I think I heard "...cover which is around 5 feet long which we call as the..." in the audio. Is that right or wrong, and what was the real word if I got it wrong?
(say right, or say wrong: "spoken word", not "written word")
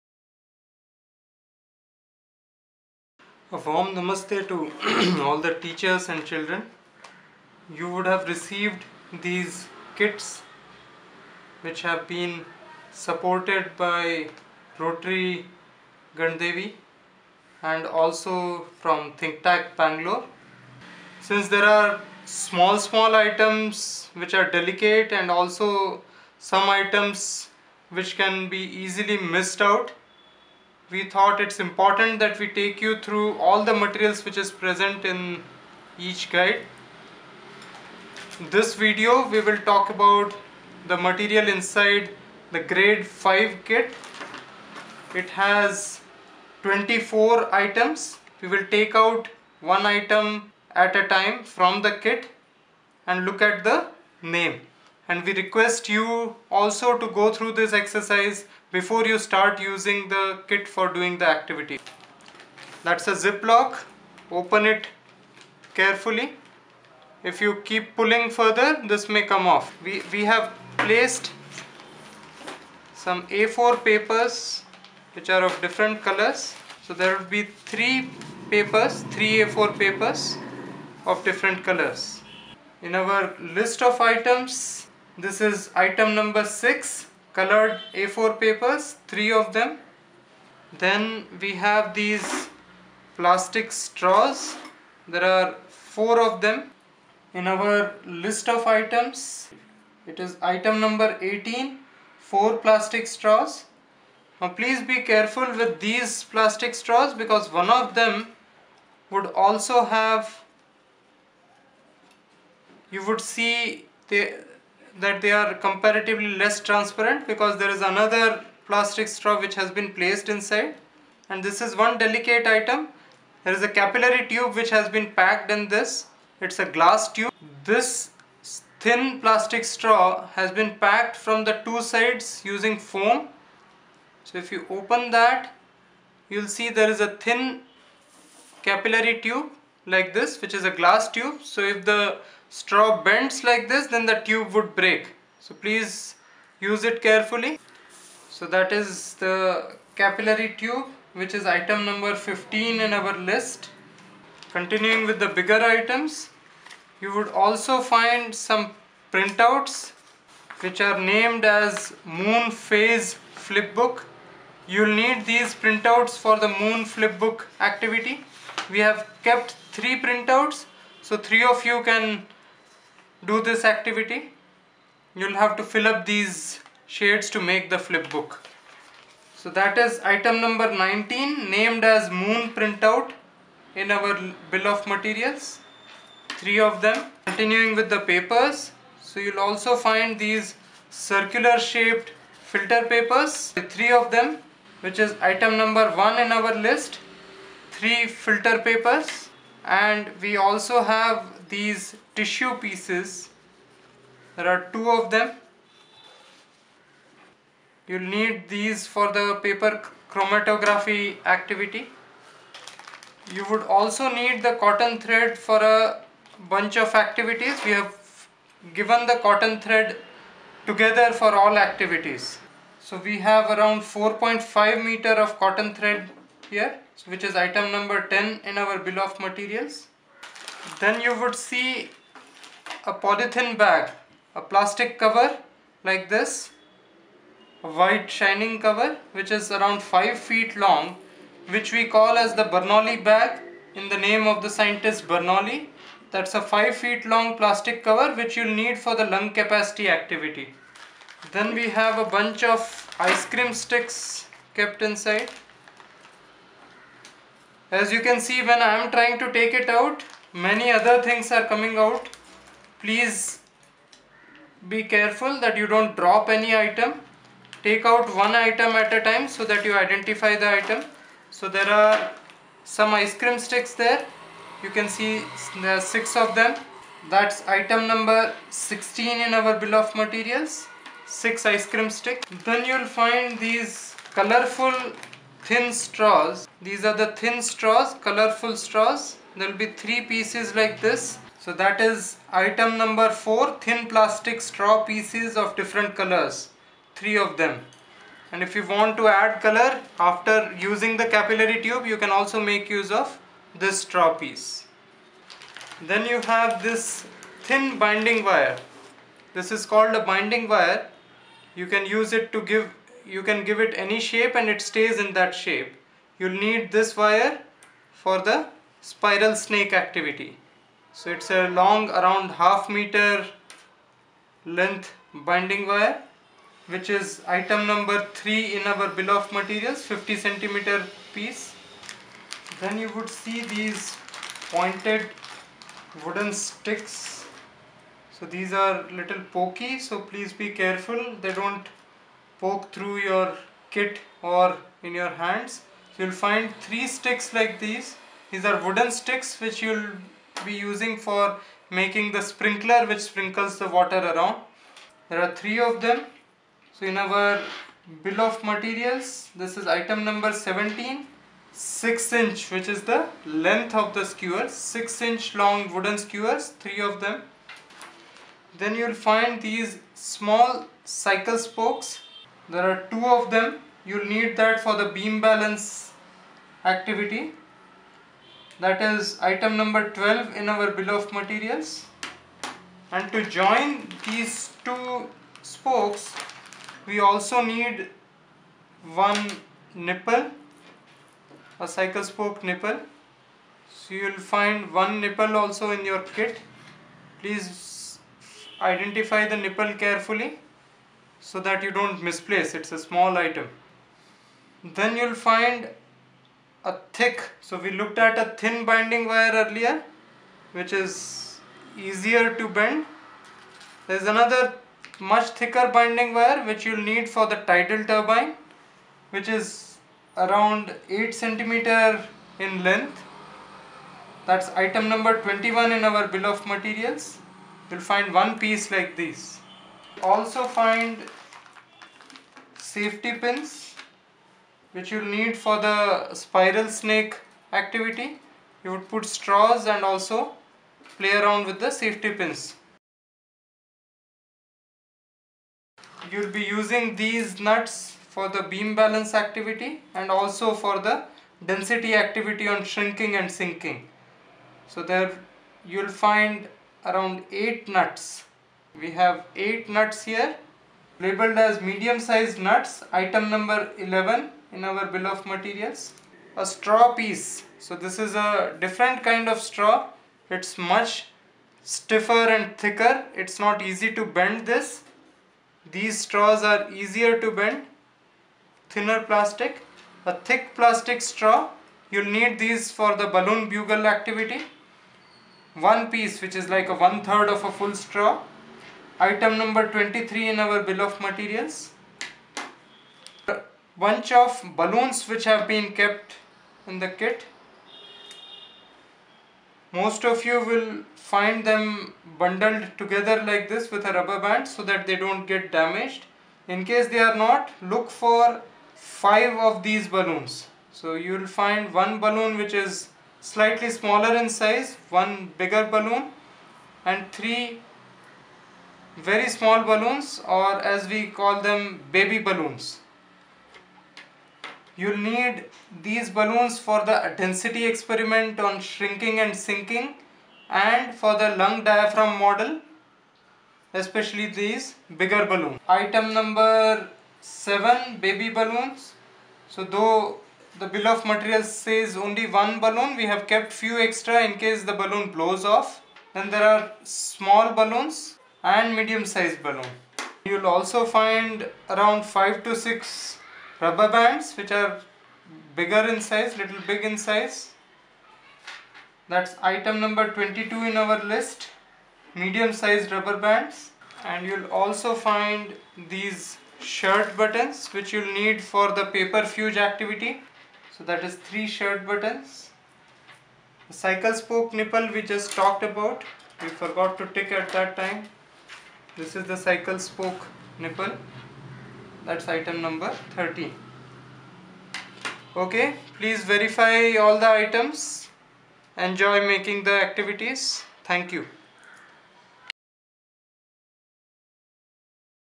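right.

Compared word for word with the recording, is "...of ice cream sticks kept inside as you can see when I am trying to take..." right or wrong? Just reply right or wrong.
right.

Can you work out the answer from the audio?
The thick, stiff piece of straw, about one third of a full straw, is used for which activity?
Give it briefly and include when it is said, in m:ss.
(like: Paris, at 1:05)
balloon bugle, at 8:03.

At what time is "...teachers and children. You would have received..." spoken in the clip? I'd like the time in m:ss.
0:05.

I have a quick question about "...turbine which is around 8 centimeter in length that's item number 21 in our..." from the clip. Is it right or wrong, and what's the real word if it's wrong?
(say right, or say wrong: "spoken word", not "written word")
right.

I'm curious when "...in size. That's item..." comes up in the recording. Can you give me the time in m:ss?
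9:16.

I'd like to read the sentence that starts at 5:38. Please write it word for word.
So these are little pokey so please be careful they don't poke through your kit or in your hands.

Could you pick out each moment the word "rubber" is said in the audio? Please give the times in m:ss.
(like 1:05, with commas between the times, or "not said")
8:23, 9:13, 9:22.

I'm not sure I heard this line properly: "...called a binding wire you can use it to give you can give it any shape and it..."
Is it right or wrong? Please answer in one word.
right.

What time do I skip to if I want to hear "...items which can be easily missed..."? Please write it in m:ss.
0:26.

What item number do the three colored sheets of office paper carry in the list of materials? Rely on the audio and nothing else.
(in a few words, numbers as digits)
6.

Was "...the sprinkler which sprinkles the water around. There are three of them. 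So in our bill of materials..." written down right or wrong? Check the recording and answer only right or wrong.
right.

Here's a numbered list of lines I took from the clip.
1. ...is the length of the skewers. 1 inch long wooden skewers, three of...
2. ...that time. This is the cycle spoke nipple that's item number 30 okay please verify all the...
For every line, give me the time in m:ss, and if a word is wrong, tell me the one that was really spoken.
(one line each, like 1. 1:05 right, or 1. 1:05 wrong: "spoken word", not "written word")
1. 6:02 wrong: "6", not "1"
2. 9:37 right.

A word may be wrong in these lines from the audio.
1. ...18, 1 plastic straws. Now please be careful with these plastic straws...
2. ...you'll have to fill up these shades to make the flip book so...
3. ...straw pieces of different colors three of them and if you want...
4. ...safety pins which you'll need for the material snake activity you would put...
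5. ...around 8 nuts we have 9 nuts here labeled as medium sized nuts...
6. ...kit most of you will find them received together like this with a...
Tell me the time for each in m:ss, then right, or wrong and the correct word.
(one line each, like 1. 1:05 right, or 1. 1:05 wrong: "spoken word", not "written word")
1. 1:41 wrong: "4", not "1"
2. 2:55 right
3. 4:54 right
4. 7:12 wrong: "spiral", not "material"
5. 7:36 wrong: "8", not "9"
6. 8:16 wrong: "bundled", not "received".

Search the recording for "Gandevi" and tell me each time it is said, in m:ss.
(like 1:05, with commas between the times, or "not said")
0:16.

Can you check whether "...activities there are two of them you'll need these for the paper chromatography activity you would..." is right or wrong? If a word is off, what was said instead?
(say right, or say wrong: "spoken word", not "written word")
wrong: "pieces", not "activities".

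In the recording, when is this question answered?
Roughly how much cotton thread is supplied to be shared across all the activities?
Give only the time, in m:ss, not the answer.
3:43.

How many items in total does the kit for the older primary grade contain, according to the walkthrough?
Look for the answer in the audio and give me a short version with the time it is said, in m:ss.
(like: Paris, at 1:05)
24, at 0:46.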